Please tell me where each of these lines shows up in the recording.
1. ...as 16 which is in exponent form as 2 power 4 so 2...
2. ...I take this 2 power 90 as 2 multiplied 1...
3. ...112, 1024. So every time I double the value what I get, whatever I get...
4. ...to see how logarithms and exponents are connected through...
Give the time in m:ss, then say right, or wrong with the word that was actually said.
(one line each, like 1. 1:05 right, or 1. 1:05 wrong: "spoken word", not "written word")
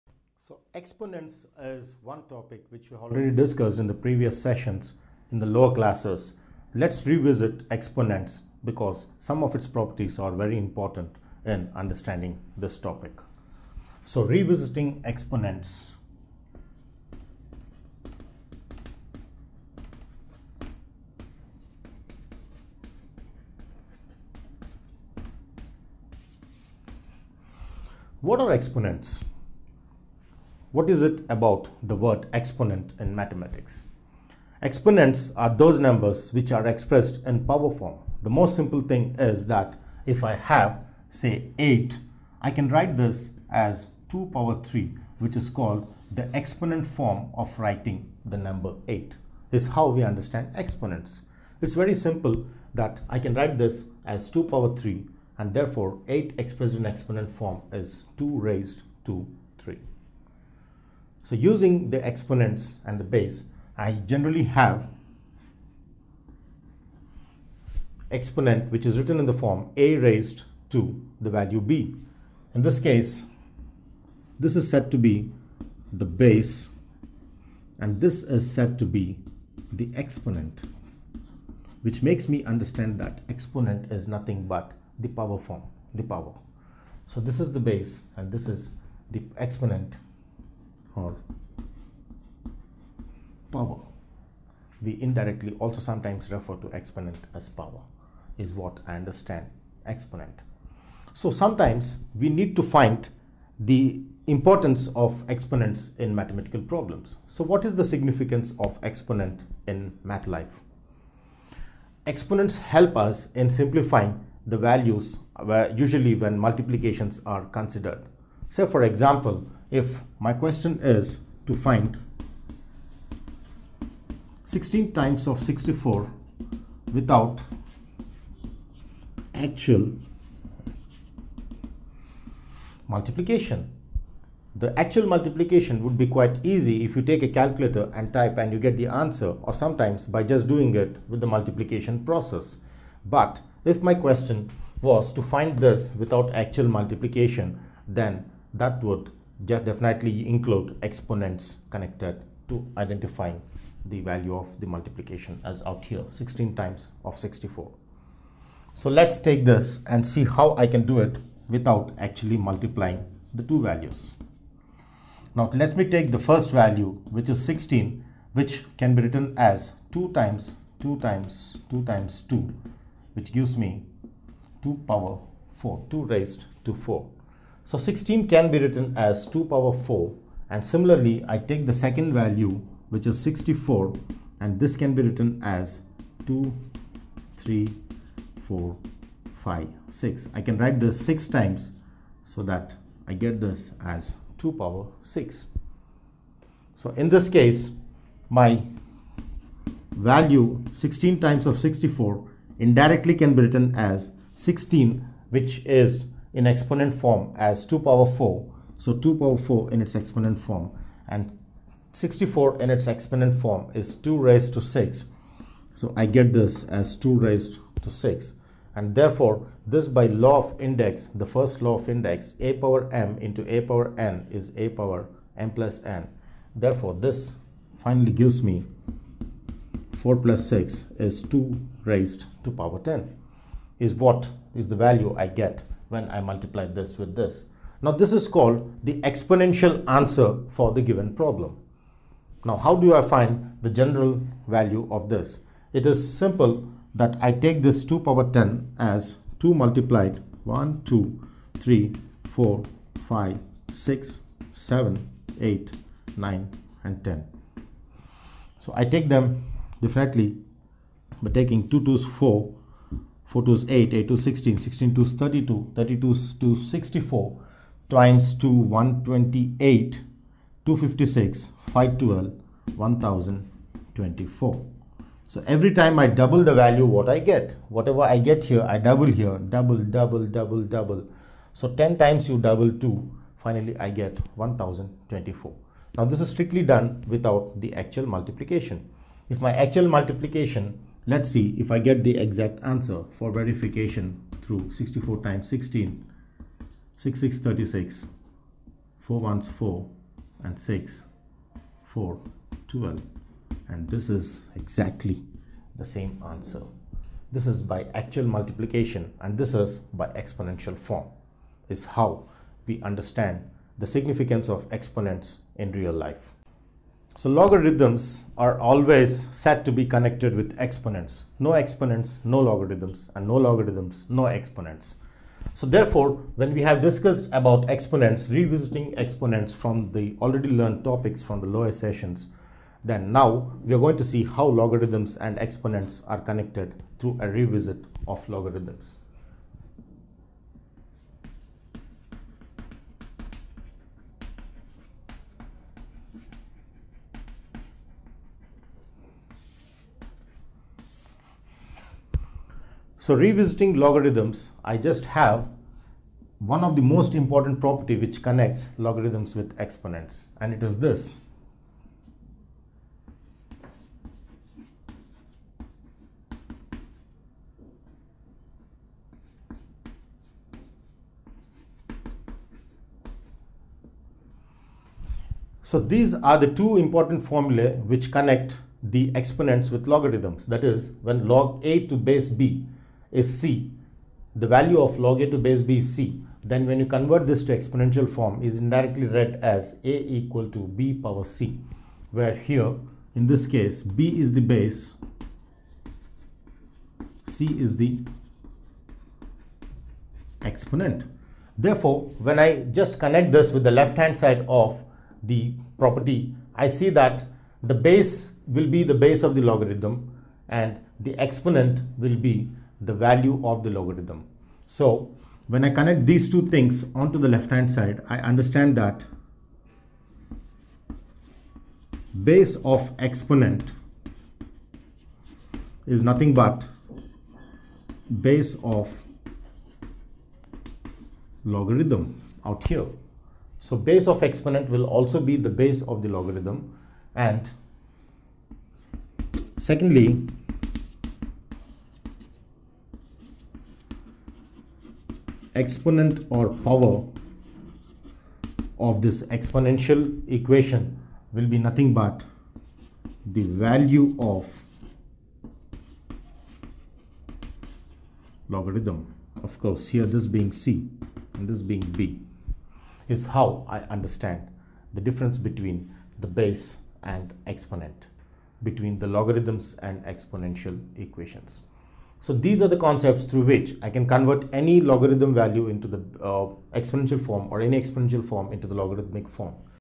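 1. 3:23 right
2. 4:07 wrong: "10", not "90"
3. 4:31 wrong: "512", not "112"
4. 5:33 right.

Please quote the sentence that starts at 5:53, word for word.
So revisiting logarithms, I just have one of the most important property which connects logarithms with exponents and it is this.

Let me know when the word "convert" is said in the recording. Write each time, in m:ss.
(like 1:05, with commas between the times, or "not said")
6:26, 7:54.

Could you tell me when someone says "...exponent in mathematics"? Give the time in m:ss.
0:32.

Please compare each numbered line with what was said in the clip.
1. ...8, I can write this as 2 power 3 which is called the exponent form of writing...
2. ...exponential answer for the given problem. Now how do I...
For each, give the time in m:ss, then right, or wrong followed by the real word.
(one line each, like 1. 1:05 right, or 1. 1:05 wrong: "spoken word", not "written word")
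1. 0:41 right
2. 3:59 right.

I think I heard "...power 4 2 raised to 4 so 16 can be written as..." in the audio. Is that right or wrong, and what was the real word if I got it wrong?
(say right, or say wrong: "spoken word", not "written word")
right.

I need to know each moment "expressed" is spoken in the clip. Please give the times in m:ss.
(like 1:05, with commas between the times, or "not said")
0:36, 0:56.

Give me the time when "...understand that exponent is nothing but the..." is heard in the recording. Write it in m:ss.
1:22.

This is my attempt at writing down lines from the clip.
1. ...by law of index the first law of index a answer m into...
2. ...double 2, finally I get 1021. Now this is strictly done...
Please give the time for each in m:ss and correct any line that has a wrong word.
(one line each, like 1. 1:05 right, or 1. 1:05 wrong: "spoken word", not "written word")
1. 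3:39 wrong: "power", not "answer"
2. 4:42 wrong: "1024", not "1021".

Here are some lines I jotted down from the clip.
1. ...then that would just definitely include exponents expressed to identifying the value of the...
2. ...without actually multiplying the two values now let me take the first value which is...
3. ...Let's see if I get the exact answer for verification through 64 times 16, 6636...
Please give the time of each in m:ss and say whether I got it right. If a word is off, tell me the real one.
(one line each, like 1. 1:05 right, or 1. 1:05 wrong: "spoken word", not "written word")
1. 2:27 wrong: "connected", not "expressed"
2. 2:41 right
3. 4:51 right.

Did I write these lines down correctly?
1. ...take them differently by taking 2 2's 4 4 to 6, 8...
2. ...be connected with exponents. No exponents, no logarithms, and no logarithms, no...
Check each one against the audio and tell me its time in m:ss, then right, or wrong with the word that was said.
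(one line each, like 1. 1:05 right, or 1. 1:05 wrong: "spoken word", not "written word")
1. 4:18 wrong: "8", not "6"
2. 5:19 right.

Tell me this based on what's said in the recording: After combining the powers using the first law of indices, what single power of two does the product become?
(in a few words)
2 raised to 10.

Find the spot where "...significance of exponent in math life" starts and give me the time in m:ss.
1:47.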